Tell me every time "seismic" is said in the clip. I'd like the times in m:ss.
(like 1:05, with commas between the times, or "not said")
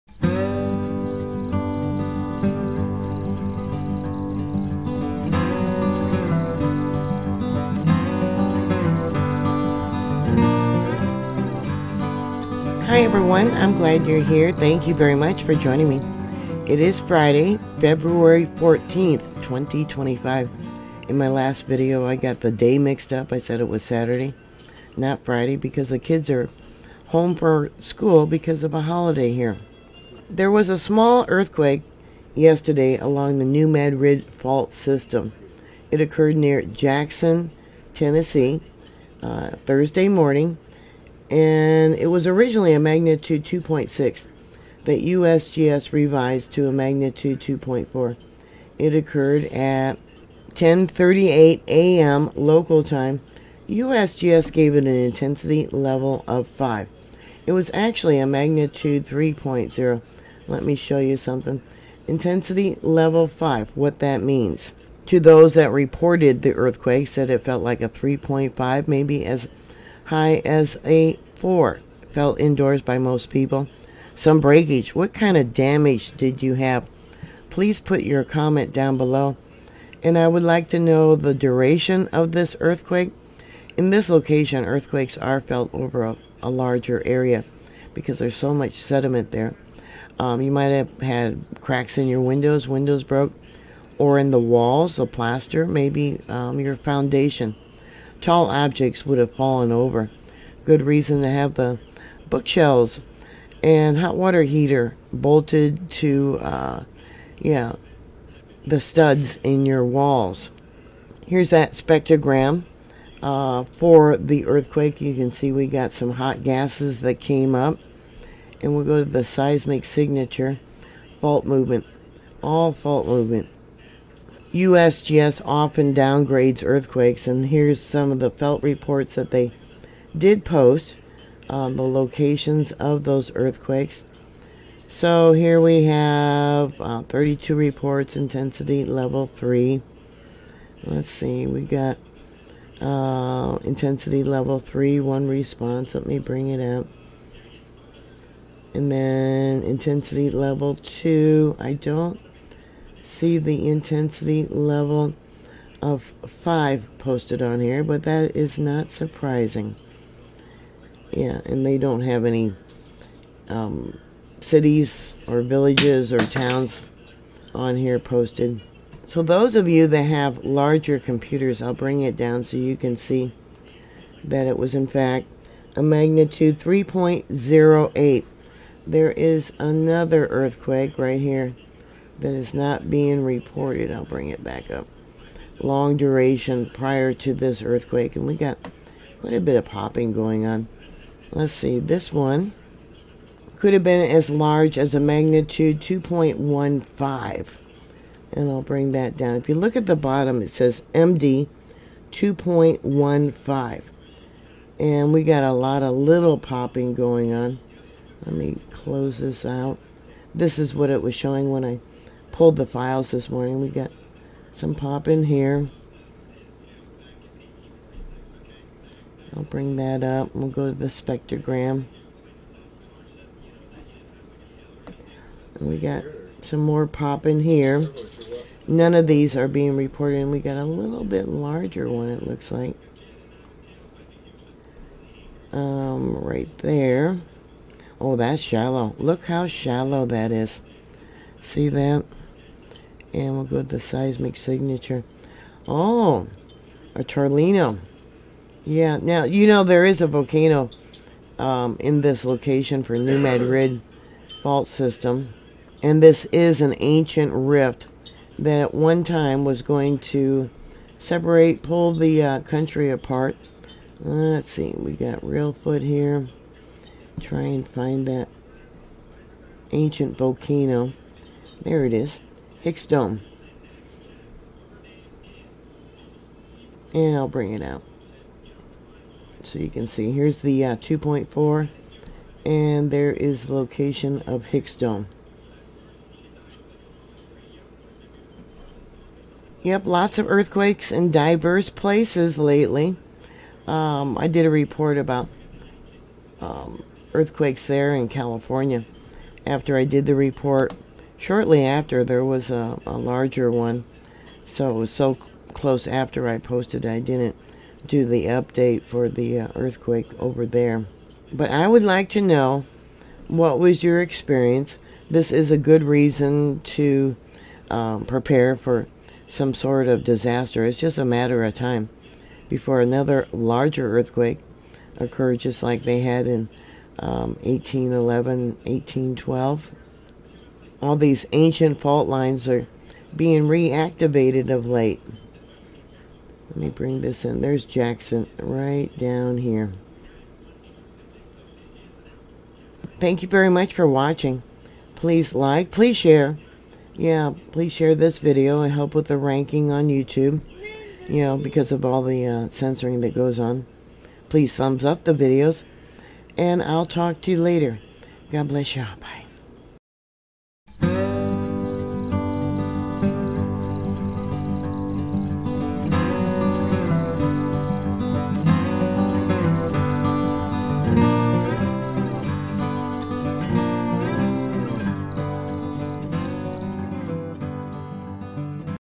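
1:59, 4:03.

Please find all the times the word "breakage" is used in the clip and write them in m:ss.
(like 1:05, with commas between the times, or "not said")
1:14.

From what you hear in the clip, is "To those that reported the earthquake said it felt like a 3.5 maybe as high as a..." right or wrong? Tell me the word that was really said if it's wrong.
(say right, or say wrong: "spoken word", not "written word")
right.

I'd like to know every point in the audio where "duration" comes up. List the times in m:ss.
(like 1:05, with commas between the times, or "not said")
1:21, 3:05.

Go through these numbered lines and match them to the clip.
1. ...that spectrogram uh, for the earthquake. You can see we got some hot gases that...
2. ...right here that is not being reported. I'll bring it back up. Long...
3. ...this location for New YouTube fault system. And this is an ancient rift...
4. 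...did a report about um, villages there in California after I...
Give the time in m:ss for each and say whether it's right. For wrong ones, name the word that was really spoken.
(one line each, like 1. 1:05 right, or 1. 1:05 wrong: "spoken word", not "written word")
1. 1:51 right
2. 3:00 right
3. 4:12 wrong: "Madrid", not "YouTube"
4. 4:54 wrong: "earthquakes", not "villages".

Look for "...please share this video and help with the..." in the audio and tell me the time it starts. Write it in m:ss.
5:47.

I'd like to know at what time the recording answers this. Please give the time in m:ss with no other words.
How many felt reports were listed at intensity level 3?
2:17.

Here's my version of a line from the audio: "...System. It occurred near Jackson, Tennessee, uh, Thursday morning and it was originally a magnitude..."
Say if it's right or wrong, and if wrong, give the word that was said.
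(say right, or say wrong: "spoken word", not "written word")
right.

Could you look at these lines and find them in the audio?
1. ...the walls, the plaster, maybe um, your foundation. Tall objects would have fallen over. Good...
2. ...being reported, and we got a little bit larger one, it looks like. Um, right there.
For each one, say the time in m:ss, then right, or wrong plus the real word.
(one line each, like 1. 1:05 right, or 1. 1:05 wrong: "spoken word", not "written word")
1. 1:34 right
2. 3:49 right.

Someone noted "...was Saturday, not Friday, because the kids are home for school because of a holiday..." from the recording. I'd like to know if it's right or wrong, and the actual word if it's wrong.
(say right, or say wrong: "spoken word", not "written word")
right.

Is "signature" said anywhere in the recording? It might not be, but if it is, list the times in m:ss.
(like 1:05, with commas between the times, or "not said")
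1:59, 4:04.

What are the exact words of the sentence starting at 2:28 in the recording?
And then intensity level 2, I don't see the intensity level of 5 posted on here, but that is not surprising.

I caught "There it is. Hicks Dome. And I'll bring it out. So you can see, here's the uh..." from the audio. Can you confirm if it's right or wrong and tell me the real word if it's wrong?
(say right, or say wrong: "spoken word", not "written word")
right.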